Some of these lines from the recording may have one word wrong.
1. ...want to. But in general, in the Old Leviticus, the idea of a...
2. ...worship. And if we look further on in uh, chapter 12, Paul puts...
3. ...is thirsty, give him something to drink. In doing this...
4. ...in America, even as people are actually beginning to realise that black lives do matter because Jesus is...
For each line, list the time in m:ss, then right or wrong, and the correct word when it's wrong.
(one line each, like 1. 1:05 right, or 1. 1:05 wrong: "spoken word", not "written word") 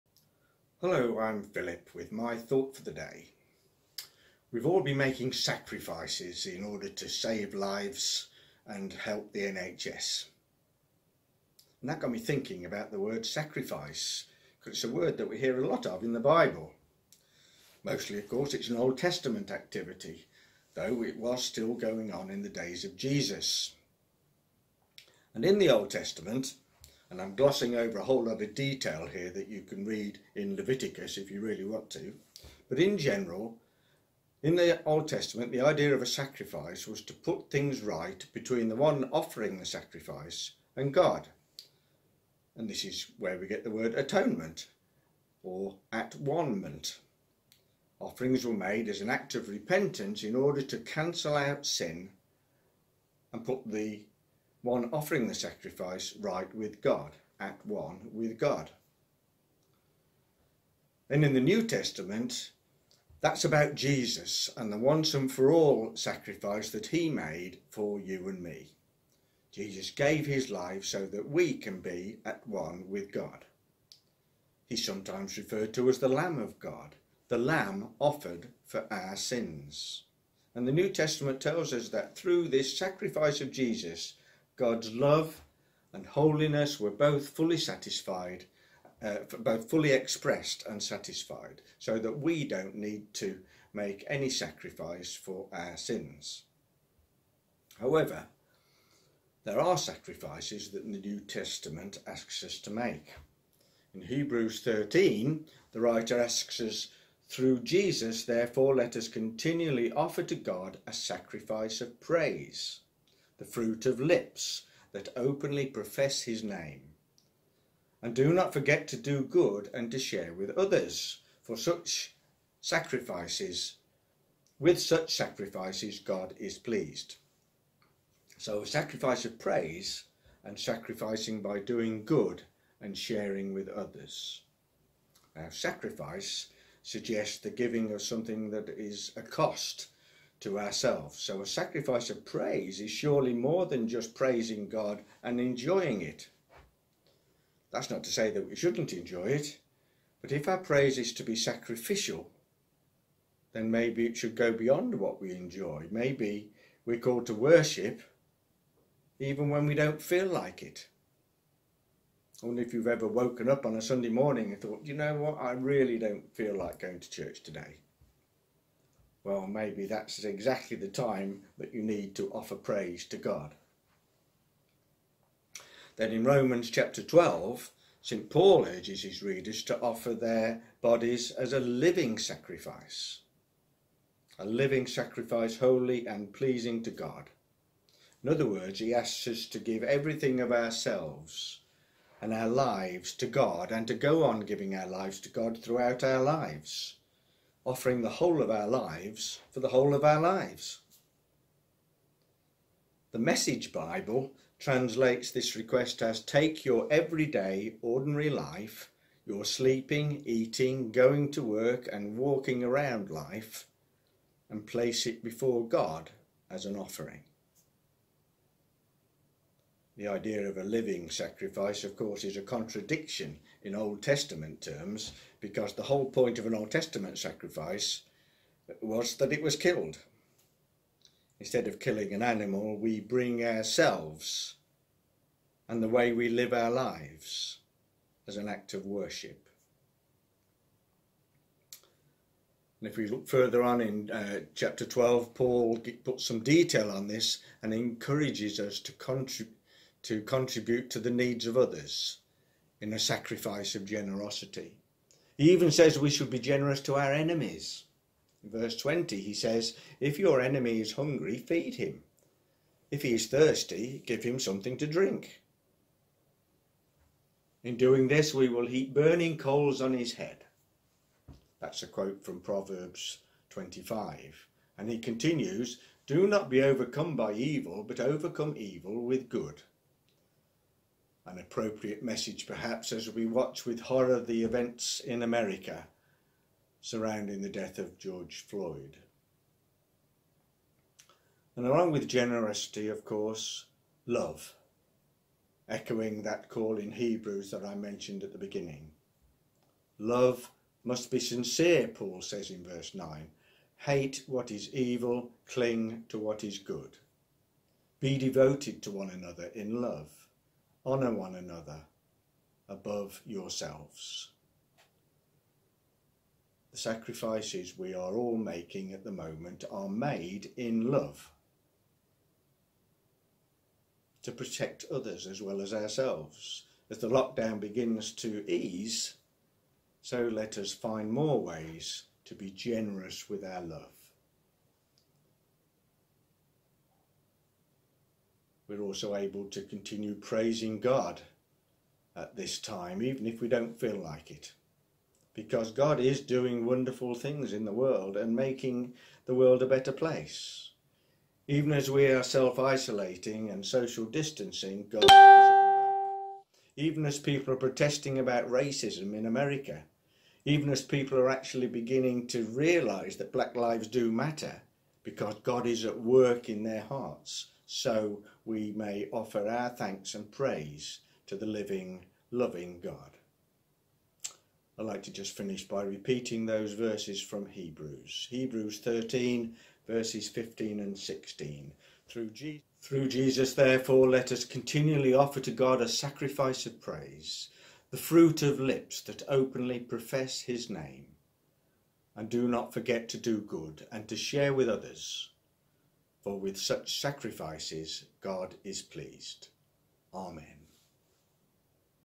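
1. 0:31 wrong: "Testament", not "Leviticus"
2. 3:58 right
3. 4:23 right
4. 5:59 wrong: "God", not "Jesus".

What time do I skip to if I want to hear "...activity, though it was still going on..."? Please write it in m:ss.
0:19.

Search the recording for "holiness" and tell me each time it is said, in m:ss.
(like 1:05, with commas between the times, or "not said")
1:26.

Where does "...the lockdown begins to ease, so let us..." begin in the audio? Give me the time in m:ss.
5:26.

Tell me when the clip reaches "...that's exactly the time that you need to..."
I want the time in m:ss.
2:49.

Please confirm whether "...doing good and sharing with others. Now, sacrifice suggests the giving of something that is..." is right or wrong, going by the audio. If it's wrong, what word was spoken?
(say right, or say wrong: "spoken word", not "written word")
right.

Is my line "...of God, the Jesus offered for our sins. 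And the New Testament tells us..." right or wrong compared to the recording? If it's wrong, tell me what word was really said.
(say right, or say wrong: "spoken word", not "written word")
wrong: "Lamb", not "Jesus".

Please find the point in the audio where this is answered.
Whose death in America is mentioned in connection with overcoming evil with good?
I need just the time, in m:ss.
4:47.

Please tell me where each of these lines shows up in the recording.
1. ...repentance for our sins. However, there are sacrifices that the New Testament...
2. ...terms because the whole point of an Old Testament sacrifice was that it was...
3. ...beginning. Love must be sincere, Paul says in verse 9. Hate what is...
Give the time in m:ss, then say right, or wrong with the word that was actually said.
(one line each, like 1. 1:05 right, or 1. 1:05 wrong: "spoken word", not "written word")
1. 1:34 wrong: "sacrifice", not "repentance"
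2. 3:44 right
3. 4:58 right.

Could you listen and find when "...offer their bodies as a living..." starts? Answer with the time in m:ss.
2:59.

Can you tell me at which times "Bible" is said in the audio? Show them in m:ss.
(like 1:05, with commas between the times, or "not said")
0:16, 3:23.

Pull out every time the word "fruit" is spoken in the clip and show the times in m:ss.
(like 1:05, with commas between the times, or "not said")
1:53, 6:27.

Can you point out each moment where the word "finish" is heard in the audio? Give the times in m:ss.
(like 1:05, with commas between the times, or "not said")
6:15.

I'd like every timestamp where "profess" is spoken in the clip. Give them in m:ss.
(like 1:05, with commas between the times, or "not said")
1:55, 6:29.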